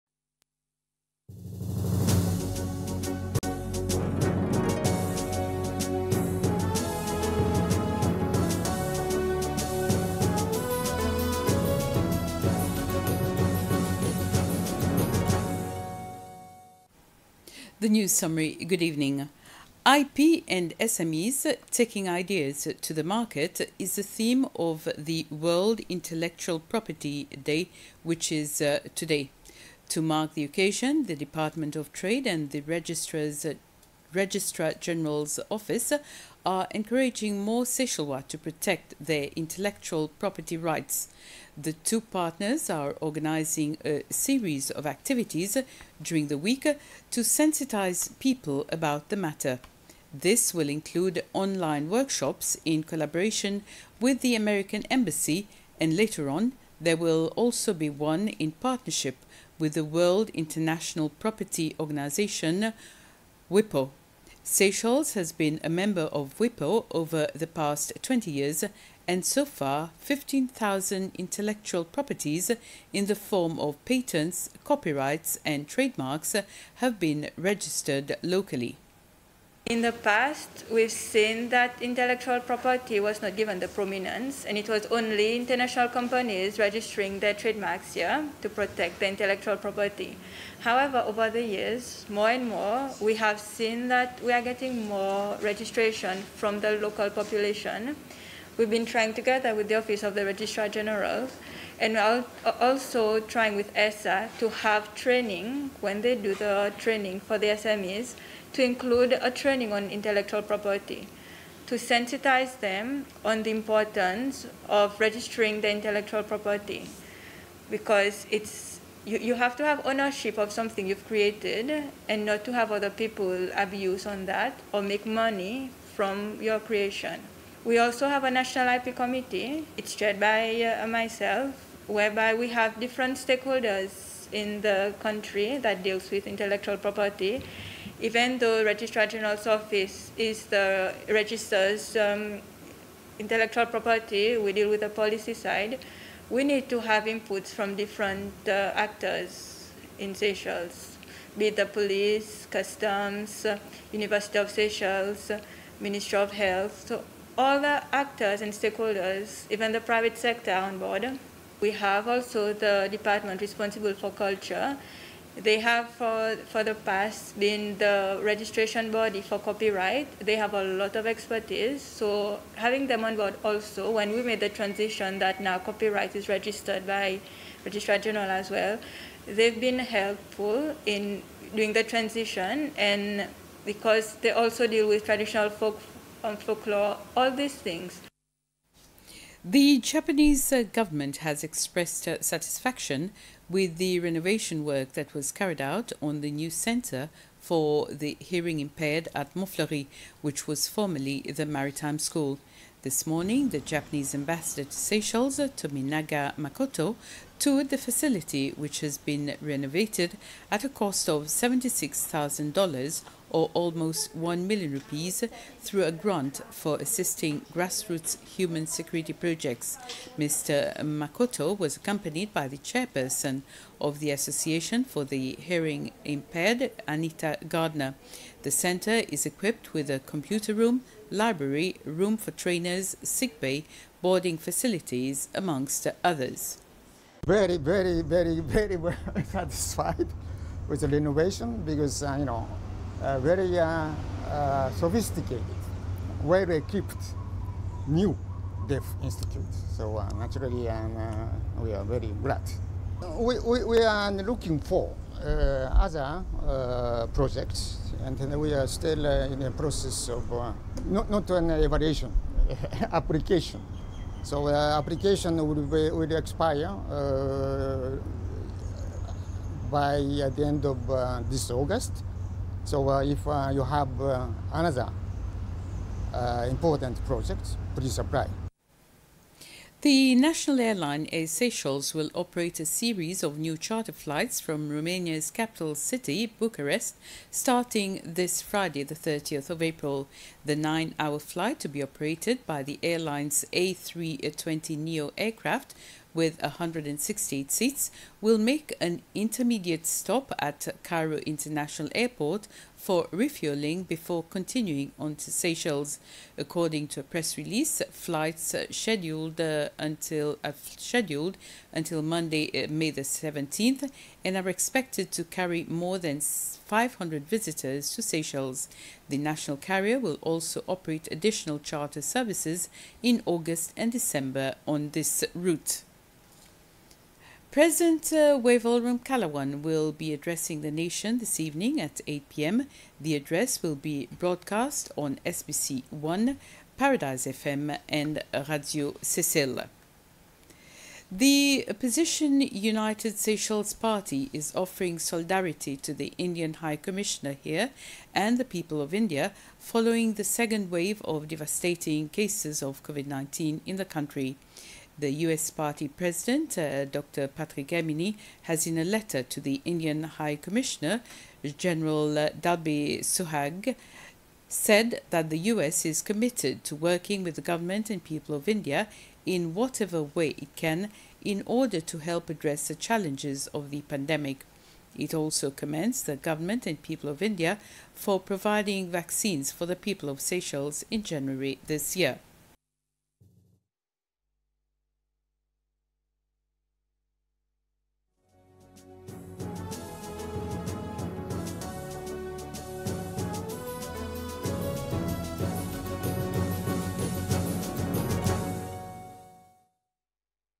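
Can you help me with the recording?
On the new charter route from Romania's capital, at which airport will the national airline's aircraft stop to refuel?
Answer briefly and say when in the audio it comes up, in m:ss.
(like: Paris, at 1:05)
Cairo International Airport, at 5:00.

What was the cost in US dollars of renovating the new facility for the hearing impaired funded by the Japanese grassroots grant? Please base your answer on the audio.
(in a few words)
$76,000.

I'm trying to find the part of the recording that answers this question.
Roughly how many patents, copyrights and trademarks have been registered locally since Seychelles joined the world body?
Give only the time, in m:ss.
1:09.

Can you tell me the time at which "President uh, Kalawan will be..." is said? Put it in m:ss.
5:27.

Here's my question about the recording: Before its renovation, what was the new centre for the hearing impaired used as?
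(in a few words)
Maritime School.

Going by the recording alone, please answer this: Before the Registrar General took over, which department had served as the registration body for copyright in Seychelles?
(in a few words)
Department responsible for culture.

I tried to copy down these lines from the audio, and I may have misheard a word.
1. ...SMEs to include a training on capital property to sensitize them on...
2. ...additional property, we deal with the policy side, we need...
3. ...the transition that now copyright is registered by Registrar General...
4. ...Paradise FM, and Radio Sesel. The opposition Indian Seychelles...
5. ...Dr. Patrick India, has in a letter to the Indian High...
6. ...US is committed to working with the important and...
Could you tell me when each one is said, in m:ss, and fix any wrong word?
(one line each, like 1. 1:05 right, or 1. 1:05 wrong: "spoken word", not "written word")
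1. 1:47 wrong: "intellectual", not "capital"
2. 2:23 wrong: "intellectual", not "additional"
3. 2:54 right
4. 5:36 wrong: "United", not "Indian"
5. 5:56 wrong: "Herminie", not "India"
6. 6:05 wrong: "government", not "important".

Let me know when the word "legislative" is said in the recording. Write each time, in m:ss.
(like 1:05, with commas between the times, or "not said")
not said.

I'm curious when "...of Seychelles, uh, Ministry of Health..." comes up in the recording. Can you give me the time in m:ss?
2:34.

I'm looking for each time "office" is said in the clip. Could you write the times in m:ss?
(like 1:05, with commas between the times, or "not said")
0:35, 1:39, 2:19.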